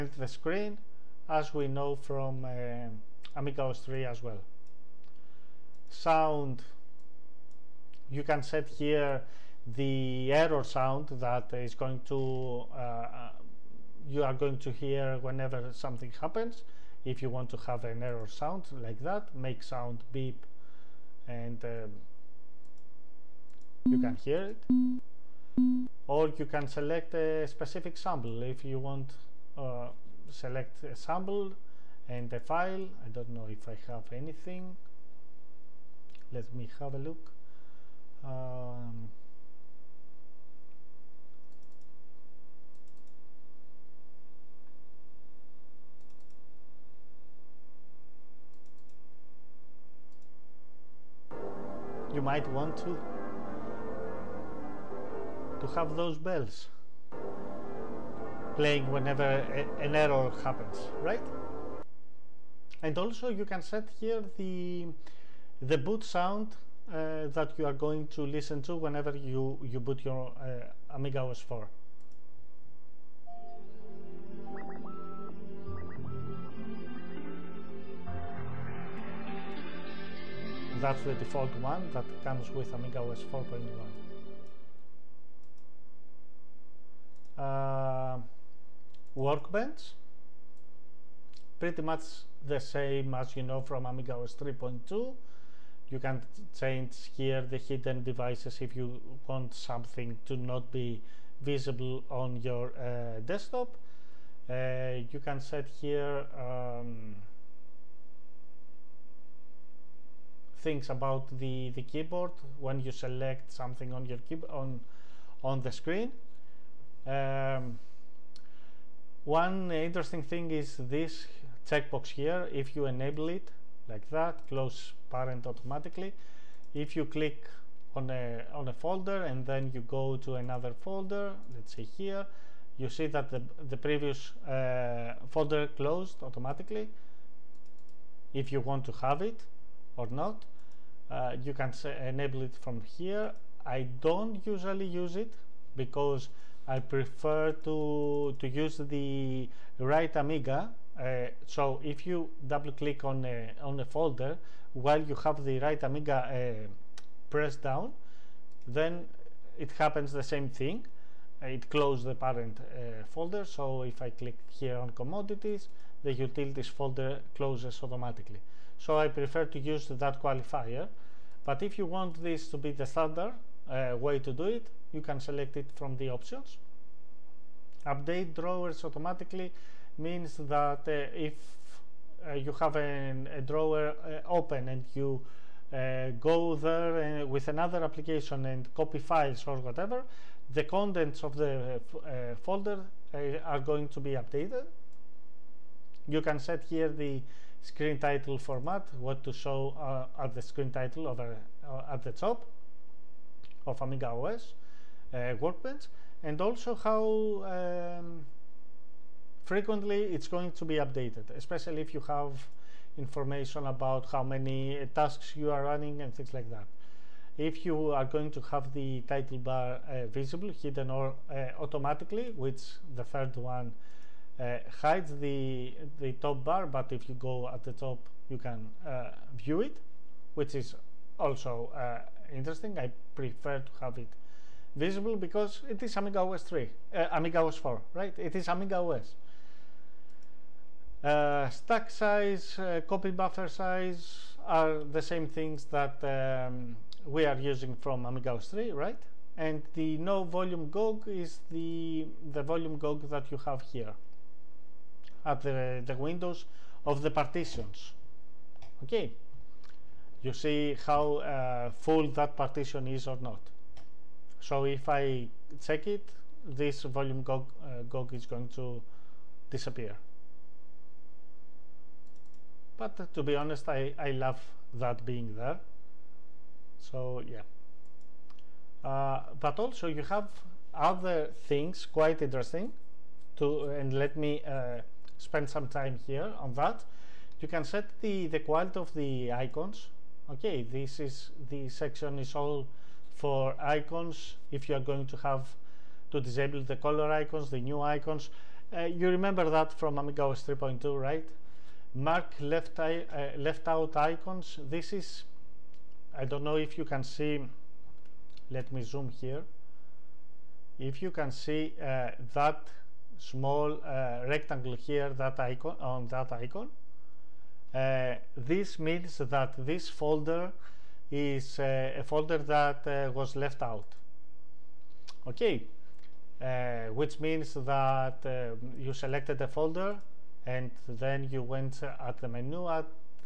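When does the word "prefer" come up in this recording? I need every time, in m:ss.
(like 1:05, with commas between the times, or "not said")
2:26, 2:49, 3:53.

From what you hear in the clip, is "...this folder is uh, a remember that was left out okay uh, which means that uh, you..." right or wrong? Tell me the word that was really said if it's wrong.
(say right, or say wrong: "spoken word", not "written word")
wrong: "folder", not "remember".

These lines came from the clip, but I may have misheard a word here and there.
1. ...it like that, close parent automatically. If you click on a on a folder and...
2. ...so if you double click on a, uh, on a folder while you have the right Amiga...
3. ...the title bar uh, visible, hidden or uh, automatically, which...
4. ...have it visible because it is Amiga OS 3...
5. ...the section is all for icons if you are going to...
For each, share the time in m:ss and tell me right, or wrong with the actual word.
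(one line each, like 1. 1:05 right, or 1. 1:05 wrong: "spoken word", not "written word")
1. 2:03 right
2. 2:31 right
3. 3:38 right
4. 3:53 right
5. 4:51 right.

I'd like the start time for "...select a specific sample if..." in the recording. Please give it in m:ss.
0:26.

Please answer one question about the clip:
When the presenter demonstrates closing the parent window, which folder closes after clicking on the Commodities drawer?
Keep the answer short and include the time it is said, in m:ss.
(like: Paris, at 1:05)
Utilities, at 2:46.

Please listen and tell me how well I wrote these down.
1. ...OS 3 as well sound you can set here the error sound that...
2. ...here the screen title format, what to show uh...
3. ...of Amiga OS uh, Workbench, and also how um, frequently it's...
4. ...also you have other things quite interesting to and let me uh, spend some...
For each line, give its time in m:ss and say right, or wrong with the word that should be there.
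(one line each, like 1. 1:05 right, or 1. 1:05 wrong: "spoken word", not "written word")
1. 0:03 right
2. 3:16 right
3. 3:23 right
4. 4:39 right.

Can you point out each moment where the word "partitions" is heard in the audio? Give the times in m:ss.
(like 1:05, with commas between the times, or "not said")
4:17, 4:22.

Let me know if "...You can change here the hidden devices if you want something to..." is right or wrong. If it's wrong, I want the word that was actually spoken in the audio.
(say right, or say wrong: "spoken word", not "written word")
right.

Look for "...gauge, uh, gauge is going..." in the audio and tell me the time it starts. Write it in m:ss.
4:27.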